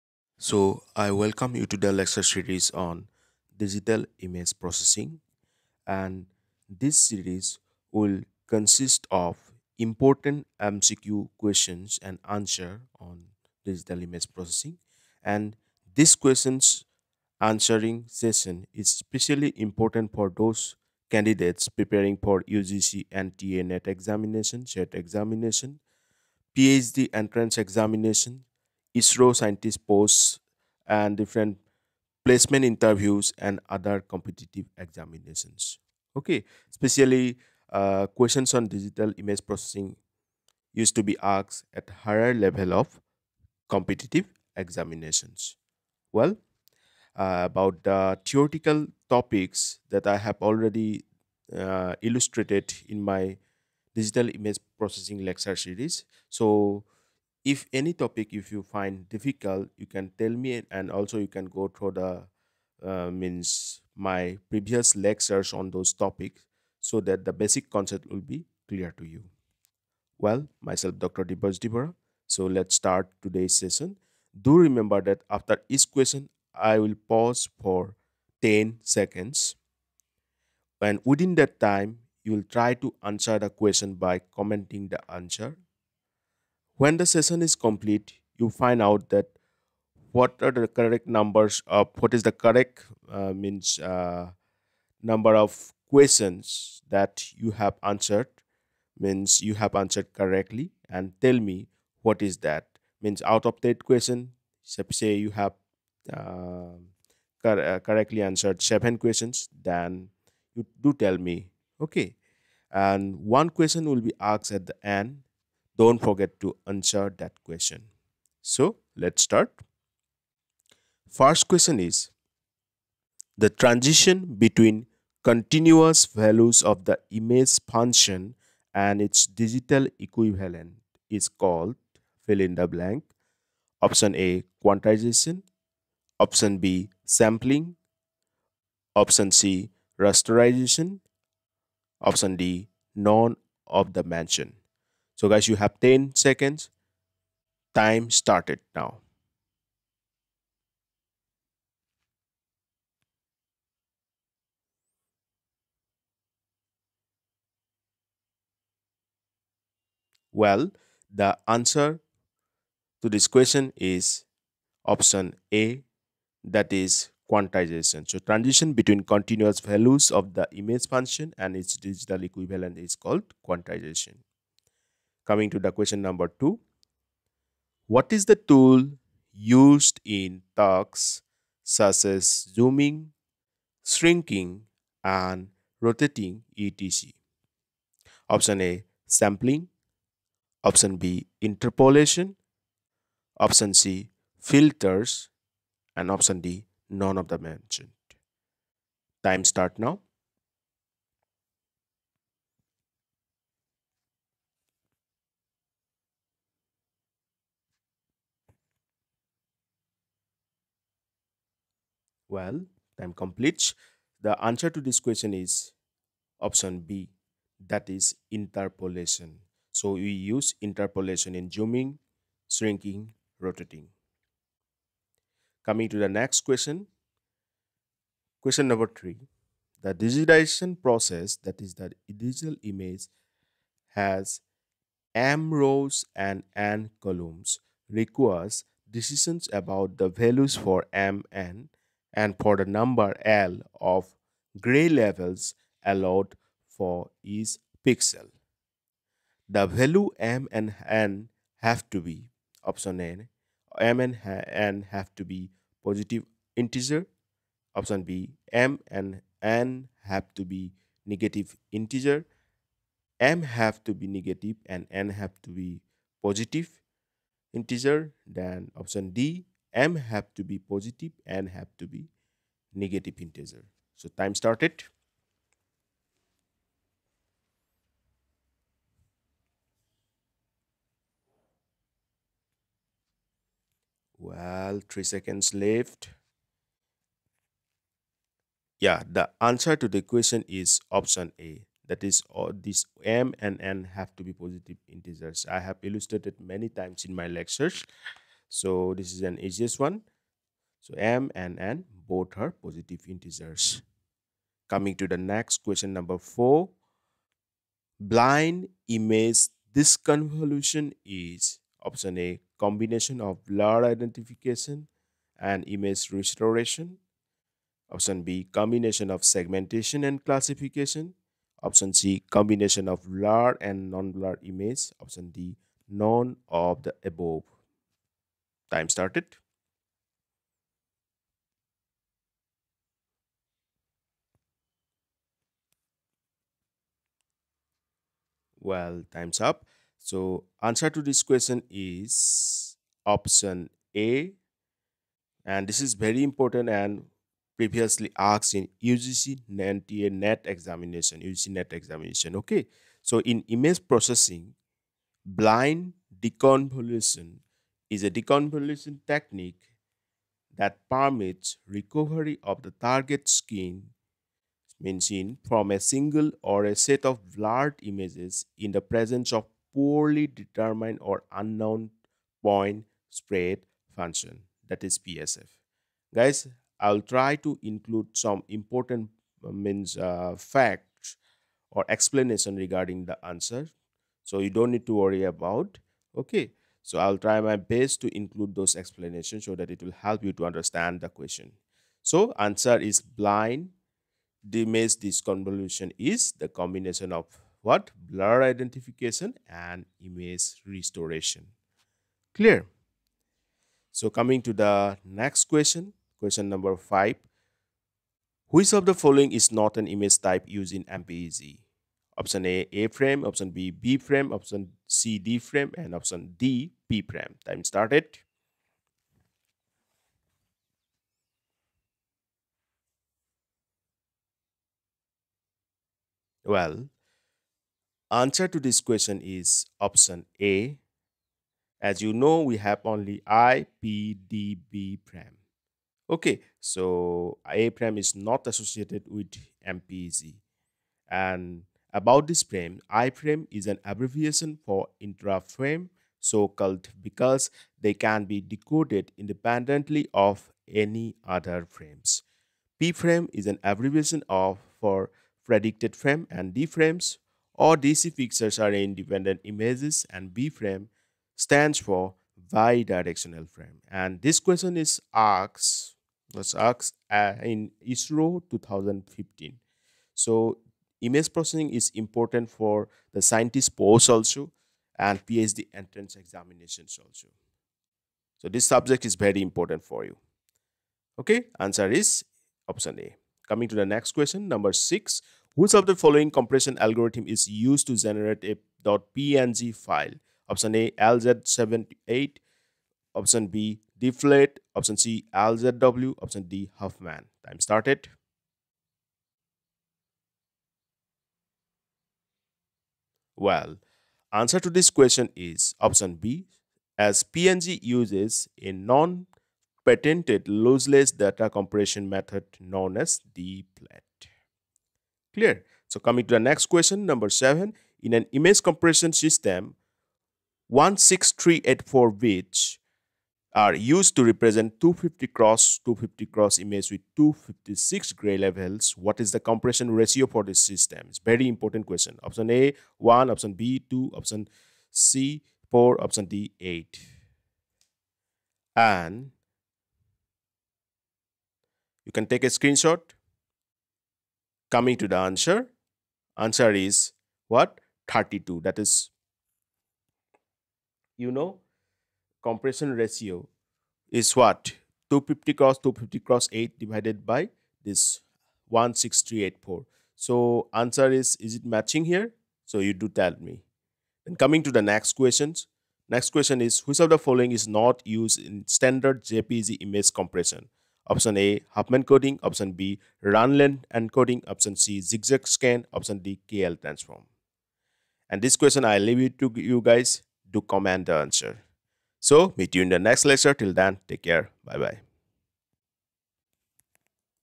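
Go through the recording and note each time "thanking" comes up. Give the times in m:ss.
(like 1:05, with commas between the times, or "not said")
not said.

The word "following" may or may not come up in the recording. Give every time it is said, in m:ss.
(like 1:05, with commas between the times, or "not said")
6:48, 8:05, 9:27.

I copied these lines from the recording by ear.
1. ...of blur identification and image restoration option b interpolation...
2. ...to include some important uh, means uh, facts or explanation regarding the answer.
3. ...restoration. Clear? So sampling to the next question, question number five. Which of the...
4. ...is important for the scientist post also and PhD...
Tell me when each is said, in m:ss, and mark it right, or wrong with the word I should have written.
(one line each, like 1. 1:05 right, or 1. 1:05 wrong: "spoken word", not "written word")
1. 5:13 wrong: "combination", not "interpolation"
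2. 6:17 right
3. 6:40 wrong: "coming", not "sampling"
4. 7:51 right.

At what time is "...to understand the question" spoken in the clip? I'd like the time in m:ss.
6:30.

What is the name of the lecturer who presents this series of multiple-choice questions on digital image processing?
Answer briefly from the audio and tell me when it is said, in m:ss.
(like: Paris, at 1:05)
Dibya Jyoti Bora, at 1:10.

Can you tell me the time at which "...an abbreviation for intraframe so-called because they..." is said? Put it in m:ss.
7:23.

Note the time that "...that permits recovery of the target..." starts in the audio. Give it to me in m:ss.
6:00.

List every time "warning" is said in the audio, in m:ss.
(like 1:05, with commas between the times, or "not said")
not said.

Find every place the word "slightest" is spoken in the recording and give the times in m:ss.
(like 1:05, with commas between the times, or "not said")
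not said.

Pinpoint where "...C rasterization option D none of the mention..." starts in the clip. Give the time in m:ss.
2:19.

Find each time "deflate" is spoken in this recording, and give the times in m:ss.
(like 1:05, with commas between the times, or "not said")
8:13, 8:33.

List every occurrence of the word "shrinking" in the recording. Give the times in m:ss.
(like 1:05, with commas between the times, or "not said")
3:03, 3:42.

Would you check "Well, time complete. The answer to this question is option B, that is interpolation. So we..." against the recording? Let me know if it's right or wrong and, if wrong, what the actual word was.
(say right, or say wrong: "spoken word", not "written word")
right.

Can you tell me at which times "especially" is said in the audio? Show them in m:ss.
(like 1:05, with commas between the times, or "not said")
0:18, 0:36.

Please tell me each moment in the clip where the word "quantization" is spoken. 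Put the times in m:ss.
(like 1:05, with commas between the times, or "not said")
2:14, 2:47, 2:53.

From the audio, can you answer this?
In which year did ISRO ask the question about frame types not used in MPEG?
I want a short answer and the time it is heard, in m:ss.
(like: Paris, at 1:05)
2015, at 7:48.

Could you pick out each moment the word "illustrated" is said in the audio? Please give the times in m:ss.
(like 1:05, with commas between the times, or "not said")
0:52, 4:55.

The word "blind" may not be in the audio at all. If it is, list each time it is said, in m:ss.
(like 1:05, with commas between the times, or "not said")
5:07, 5:55, 6:33.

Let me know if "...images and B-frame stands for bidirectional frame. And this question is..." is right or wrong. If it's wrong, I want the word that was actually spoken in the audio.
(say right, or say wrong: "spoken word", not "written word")
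right.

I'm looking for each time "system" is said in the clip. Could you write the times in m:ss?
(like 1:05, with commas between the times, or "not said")
8:39, 8:50.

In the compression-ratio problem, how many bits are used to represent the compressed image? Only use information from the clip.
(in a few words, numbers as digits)
16384.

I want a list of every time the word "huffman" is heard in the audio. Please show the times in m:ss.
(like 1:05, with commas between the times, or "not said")
8:16, 9:31.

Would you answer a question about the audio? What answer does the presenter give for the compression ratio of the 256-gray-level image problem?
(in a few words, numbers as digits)
32.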